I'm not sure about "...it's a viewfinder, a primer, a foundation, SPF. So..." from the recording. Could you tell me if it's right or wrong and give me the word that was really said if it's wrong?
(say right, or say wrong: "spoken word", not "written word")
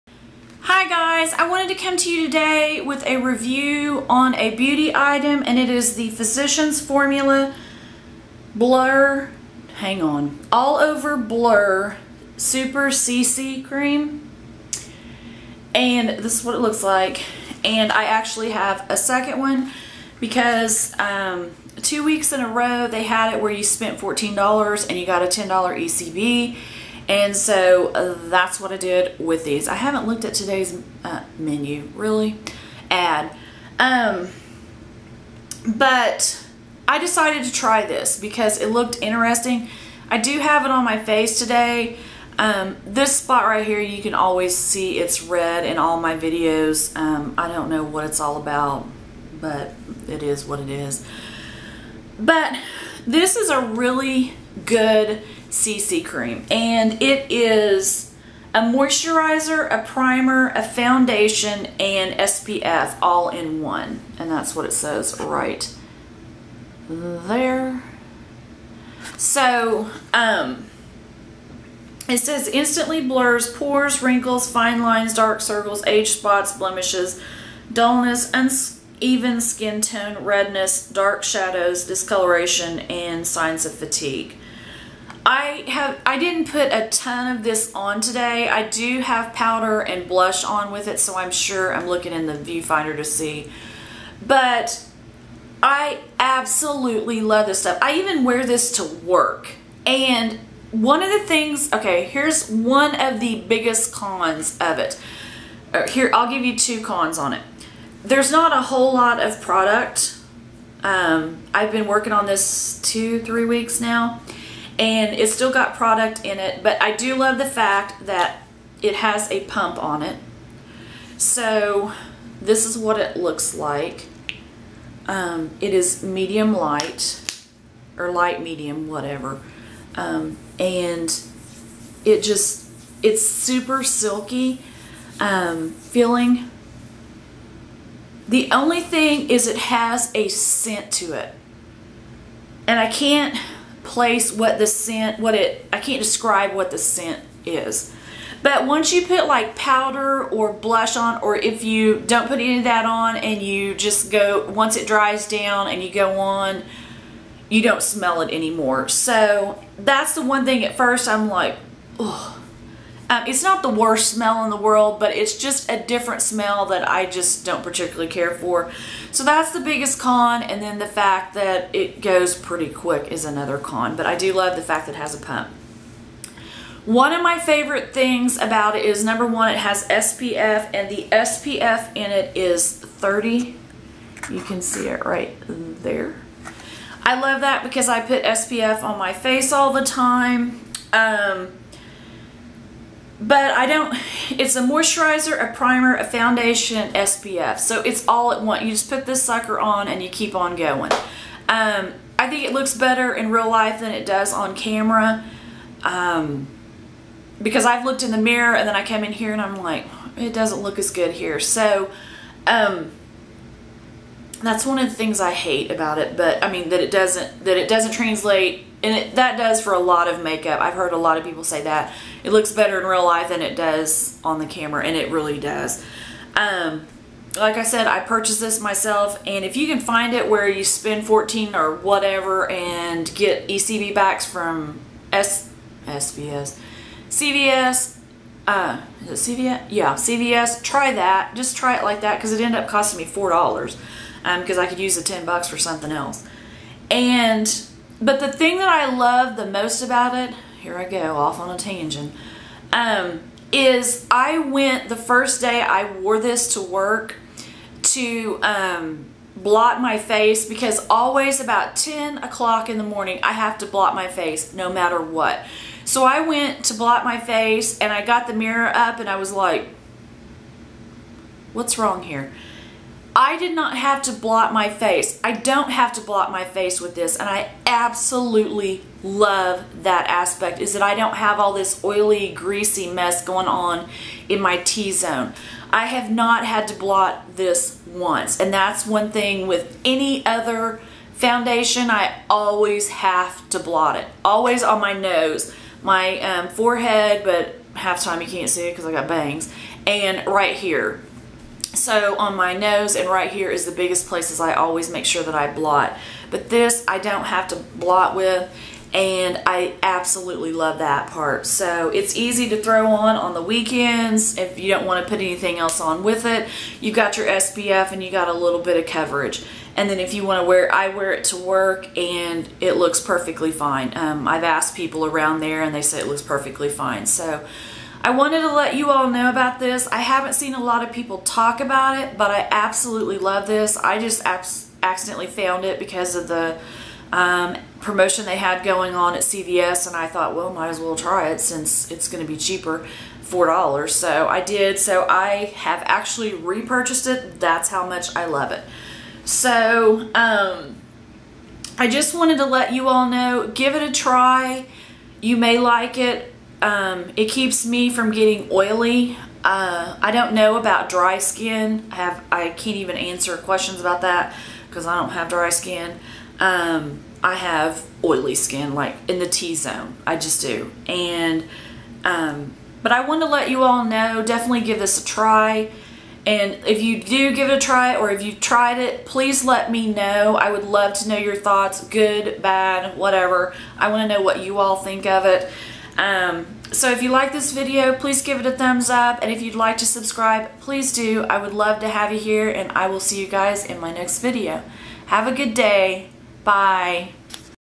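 wrong: "moisturizer", not "viewfinder".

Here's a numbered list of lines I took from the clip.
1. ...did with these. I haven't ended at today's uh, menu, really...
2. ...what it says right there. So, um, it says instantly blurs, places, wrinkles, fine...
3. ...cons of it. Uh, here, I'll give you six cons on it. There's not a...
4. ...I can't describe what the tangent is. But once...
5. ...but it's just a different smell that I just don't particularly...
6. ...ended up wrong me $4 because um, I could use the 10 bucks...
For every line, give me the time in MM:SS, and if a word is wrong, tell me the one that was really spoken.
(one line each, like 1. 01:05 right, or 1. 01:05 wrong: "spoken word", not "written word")
1. 00:28 wrong: "looked", not "ended"
2. 01:04 wrong: "pores", not "places"
3. 01:43 wrong: "two", not "six"
4. 02:25 wrong: "scent", not "tangent"
5. 02:44 right
6. 04:02 wrong: "costing", not "wrong".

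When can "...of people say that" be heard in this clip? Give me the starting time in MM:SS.
03:41.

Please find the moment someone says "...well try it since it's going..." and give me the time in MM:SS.
05:40.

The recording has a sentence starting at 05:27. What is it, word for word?
So I wanted to let you all know about this.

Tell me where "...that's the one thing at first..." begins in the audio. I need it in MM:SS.
02:39.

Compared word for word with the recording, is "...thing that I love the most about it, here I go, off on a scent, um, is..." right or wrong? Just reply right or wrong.
wrong.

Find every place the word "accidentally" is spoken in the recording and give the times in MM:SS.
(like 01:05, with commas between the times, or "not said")
05:34.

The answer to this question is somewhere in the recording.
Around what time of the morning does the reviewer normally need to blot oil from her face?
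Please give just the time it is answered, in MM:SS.
04:21.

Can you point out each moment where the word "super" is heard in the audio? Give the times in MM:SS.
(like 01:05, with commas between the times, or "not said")
00:12, 02:13.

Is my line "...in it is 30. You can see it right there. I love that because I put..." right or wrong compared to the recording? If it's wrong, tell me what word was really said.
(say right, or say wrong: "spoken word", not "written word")
right.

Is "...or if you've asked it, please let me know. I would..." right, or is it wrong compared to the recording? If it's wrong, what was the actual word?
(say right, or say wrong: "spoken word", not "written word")
wrong: "tried", not "asked".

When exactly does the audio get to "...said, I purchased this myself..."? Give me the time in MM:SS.
03:47.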